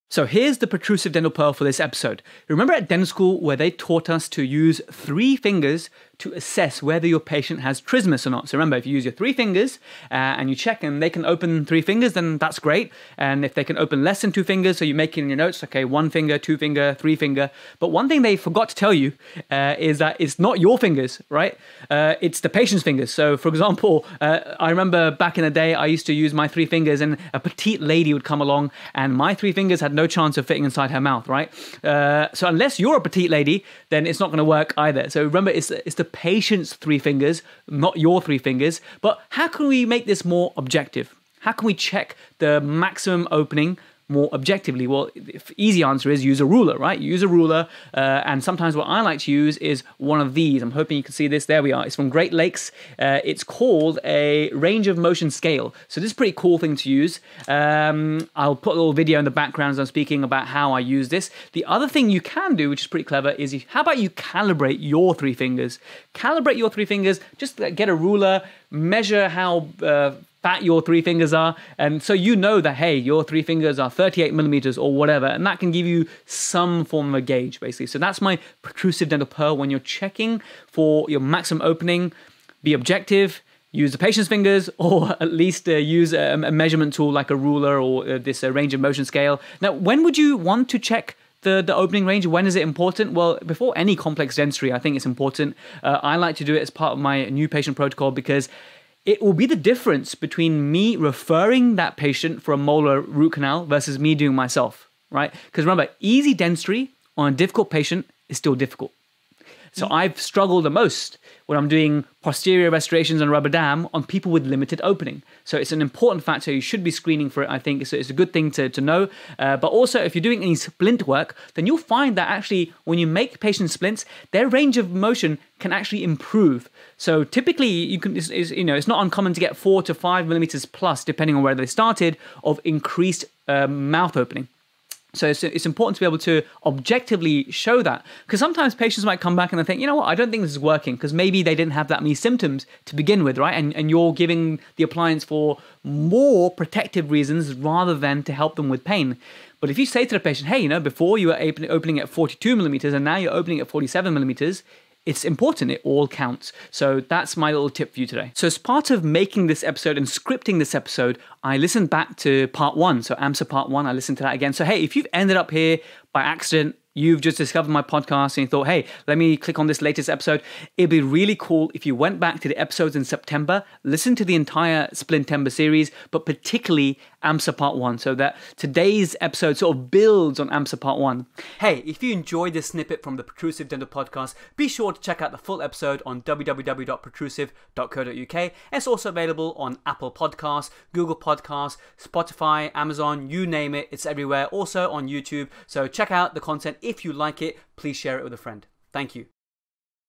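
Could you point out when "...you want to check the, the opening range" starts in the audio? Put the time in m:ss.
1:30.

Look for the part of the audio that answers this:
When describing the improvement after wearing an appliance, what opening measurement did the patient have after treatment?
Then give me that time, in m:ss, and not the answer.
2:33.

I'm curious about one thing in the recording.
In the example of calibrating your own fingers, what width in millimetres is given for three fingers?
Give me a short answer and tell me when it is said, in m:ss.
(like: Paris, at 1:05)
38 millimeters, at 1:13.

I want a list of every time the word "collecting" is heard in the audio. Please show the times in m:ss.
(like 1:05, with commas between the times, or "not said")
not said.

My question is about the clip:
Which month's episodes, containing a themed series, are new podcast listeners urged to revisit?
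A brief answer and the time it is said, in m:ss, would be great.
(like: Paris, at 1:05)
September, at 2:53.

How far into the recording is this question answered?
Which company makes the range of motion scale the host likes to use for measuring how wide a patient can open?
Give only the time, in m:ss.
0:52.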